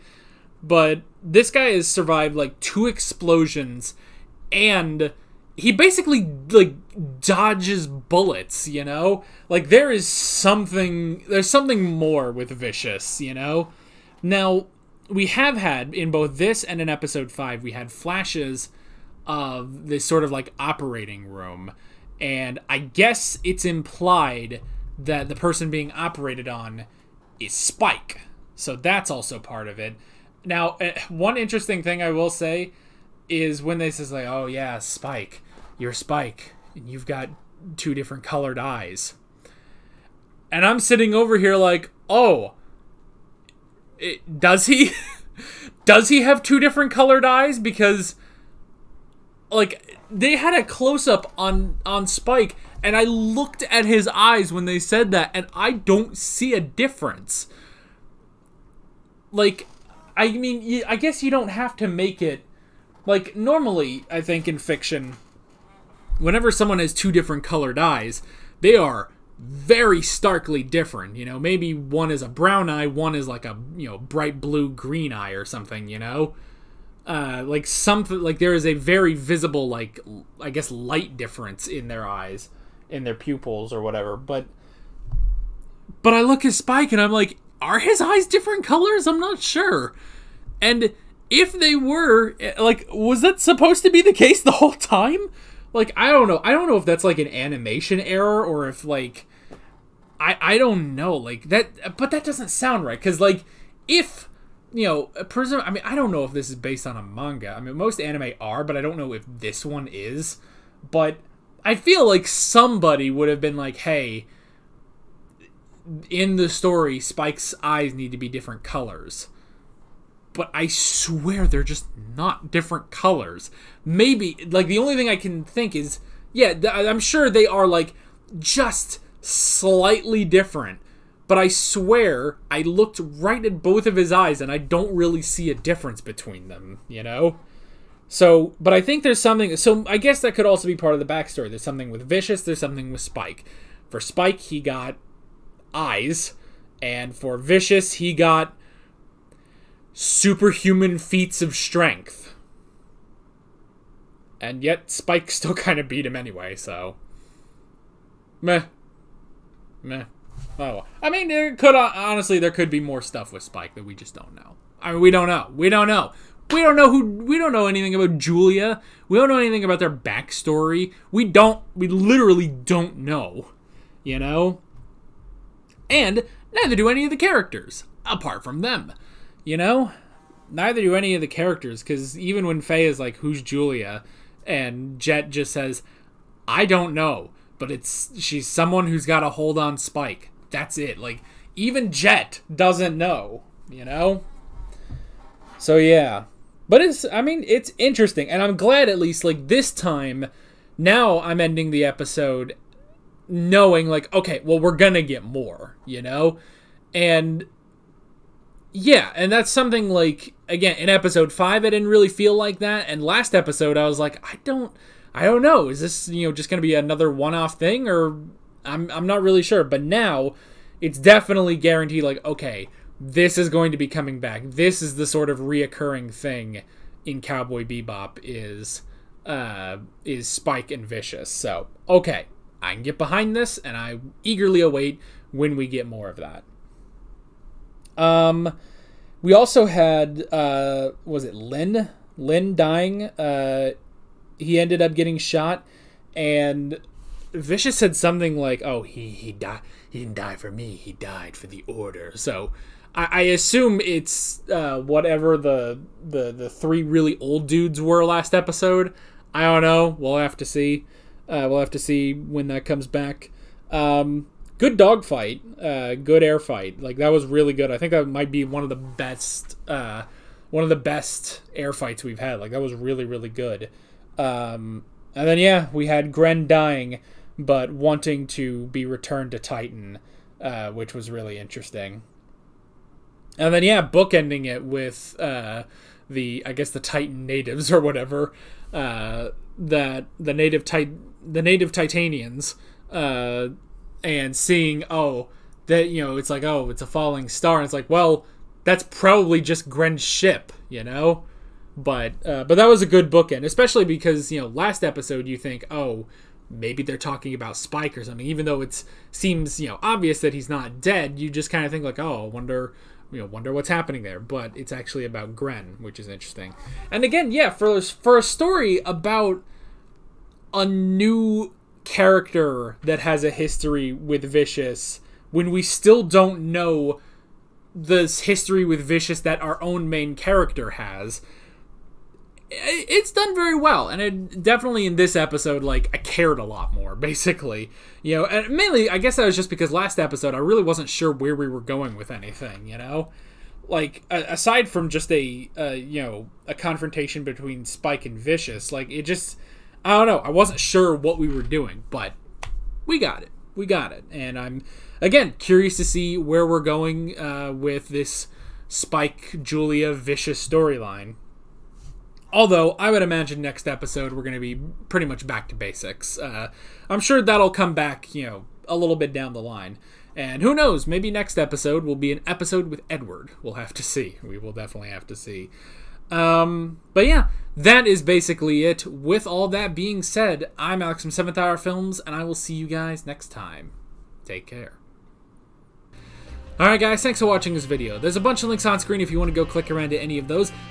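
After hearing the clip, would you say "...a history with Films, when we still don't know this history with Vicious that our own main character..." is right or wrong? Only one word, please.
wrong.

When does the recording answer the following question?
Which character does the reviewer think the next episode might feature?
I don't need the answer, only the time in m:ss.
6:12.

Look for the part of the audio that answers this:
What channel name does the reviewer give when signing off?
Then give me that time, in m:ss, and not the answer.
6:21.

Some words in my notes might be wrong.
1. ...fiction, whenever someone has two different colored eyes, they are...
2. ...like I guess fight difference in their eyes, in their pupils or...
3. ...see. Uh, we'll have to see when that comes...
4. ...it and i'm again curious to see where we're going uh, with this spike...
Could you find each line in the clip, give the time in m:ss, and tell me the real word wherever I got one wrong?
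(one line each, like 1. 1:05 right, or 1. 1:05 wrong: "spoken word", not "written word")
1. 1:04 right
2. 1:19 wrong: "light", not "fight"
3. 4:20 right
4. 5:53 right.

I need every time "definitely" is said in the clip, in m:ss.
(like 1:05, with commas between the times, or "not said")
3:40, 5:34, 6:14.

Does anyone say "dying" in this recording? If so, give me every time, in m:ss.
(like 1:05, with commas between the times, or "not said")
4:02, 4:36.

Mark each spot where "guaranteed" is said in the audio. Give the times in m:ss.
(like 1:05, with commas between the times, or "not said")
3:41.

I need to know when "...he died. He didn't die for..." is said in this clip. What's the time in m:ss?
4:09.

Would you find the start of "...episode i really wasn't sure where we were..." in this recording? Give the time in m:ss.
5:39.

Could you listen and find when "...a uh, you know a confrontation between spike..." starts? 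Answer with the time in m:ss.
5:45.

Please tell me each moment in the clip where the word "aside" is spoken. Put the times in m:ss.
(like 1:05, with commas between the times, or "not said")
5:44.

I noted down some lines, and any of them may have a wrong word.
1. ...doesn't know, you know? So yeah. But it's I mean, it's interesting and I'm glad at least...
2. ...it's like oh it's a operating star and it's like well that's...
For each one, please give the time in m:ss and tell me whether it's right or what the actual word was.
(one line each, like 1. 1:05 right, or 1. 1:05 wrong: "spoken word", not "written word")
1. 3:12 right
2. 4:56 wrong: "falling", not "operating".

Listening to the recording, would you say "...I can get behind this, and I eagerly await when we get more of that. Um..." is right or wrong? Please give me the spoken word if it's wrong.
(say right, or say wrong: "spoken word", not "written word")
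right.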